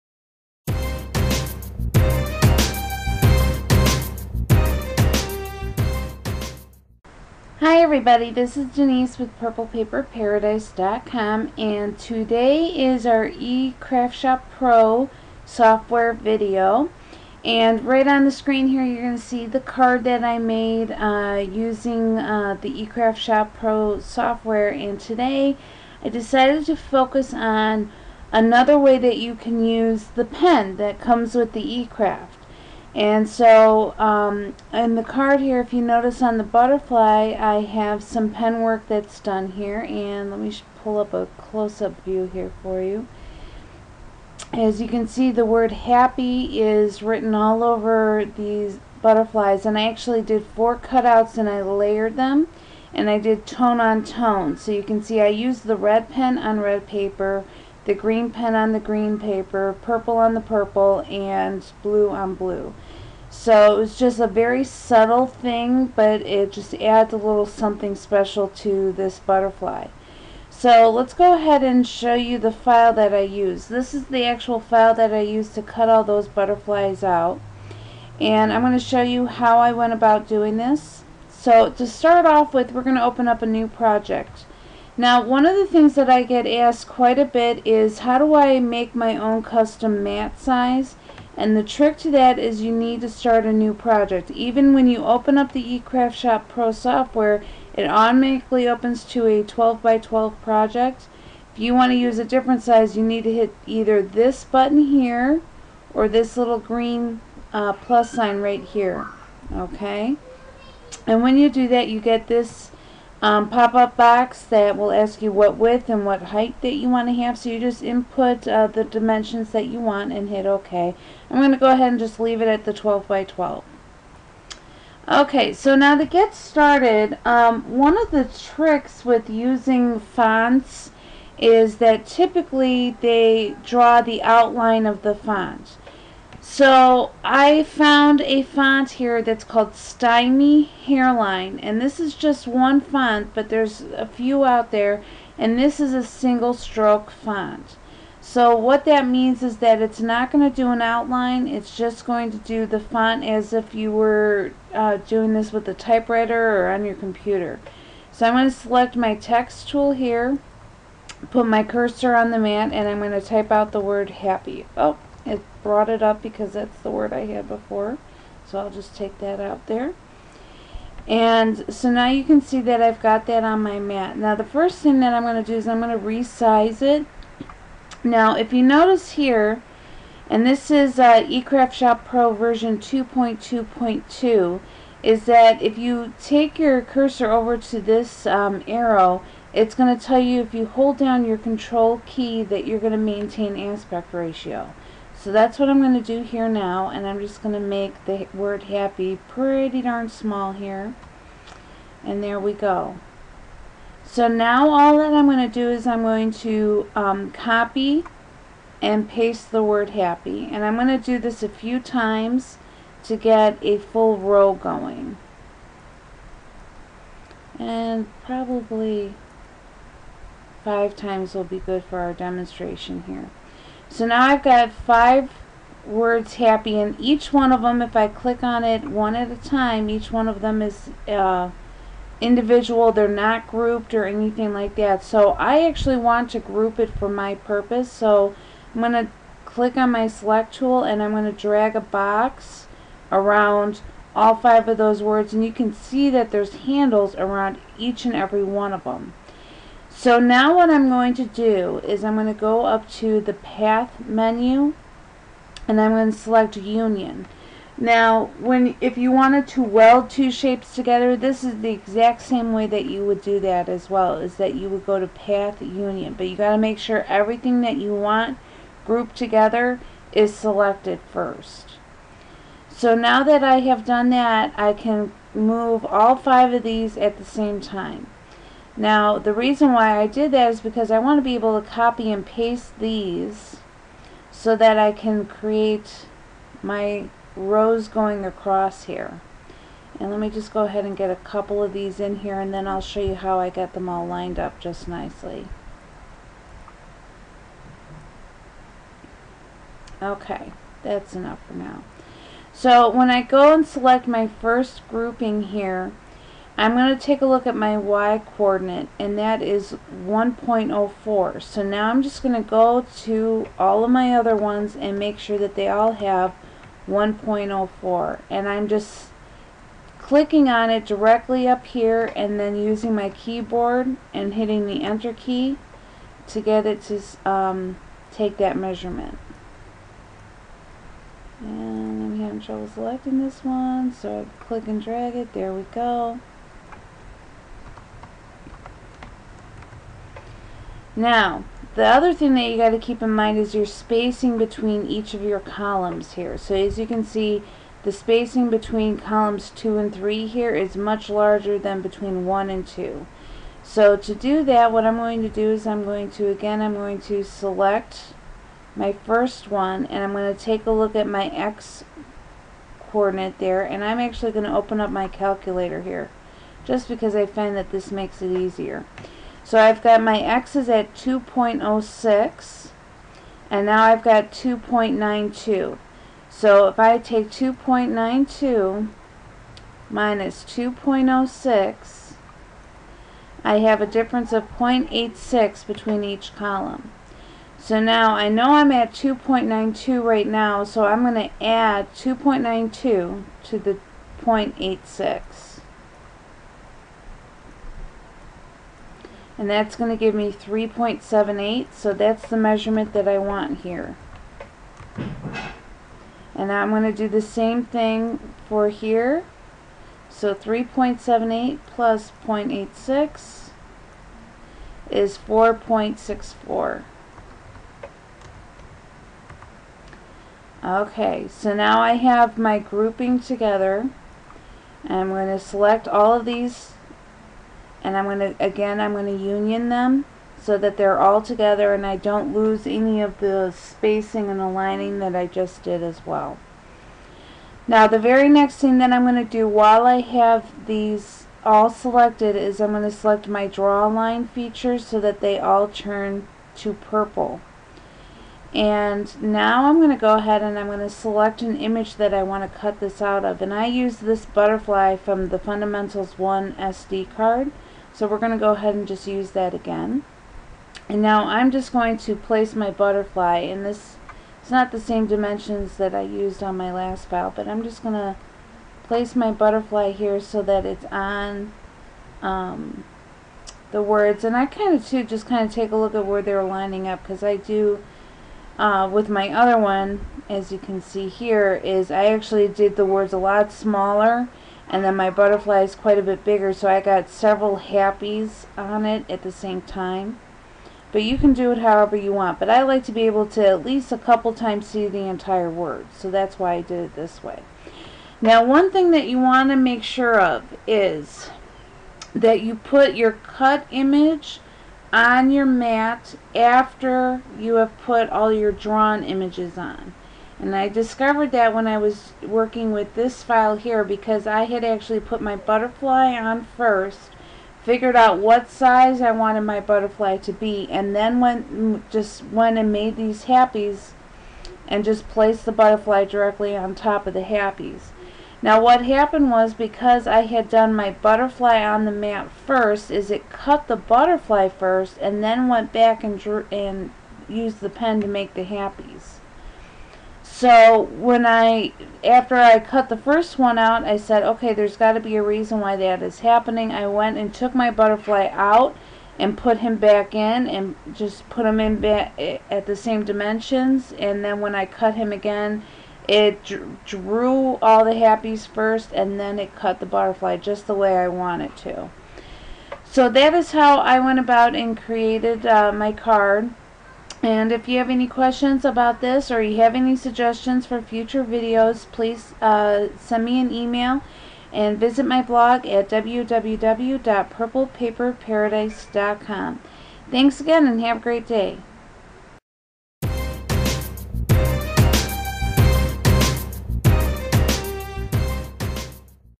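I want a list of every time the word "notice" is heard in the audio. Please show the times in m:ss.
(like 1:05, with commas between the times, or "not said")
0:35, 2:58.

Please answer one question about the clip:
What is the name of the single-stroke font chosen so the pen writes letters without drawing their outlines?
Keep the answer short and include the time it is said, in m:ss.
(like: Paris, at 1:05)
Stymie Hairline, at 2:19.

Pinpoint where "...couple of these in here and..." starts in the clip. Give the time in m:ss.
4:51.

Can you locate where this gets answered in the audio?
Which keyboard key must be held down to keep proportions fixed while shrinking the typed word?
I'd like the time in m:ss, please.
3:11.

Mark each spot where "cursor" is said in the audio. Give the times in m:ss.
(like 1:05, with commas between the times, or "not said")
2:41, 3:06.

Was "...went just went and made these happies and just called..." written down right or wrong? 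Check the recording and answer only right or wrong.
wrong.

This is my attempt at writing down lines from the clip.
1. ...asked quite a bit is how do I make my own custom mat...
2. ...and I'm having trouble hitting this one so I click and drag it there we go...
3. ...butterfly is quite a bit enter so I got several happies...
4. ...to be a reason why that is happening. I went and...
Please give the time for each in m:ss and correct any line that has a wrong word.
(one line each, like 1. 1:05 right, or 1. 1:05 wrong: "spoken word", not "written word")
1. 1:26 right
2. 5:31 wrong: "selecting", not "hitting"
3. 8:05 wrong: "bigger", not "enter"
4. 9:04 right.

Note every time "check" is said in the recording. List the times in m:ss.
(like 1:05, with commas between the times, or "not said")
not said.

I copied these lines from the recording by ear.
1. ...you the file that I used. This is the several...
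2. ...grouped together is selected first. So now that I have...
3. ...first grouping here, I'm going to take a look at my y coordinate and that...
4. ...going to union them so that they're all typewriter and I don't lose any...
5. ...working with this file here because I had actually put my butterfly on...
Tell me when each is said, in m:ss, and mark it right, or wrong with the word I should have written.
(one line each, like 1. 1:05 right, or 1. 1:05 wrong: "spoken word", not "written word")
1. 1:12 wrong: "actual", not "several"
2. 4:28 right
3. 5:04 right
4. 7:08 wrong: "together", not "typewriter"
5. 8:32 right.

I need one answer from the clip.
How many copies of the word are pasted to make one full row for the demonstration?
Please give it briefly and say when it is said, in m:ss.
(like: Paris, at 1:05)
5, at 3:40.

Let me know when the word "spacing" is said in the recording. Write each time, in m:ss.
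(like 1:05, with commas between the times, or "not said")
5:43, 5:47, 7:13.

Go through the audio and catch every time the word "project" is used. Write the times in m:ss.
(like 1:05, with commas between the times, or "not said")
1:23, 1:33, 1:40.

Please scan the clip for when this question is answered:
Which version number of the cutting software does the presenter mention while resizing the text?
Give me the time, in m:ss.
3:02.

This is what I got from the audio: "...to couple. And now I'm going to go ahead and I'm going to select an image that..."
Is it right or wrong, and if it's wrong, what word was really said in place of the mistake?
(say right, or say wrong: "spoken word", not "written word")
wrong: "purple", not "couple".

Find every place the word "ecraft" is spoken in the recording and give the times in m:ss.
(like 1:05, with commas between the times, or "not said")
0:13, 0:22, 0:31, 1:35, 3:01.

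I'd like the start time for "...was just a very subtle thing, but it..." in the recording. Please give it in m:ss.
1:03.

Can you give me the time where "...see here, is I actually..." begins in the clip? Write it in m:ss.
8:00.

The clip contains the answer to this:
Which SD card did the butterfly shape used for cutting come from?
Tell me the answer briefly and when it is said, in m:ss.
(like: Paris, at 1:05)
Fundamentals 1, at 7:35.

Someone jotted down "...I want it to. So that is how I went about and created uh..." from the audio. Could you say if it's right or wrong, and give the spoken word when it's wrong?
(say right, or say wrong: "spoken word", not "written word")
right.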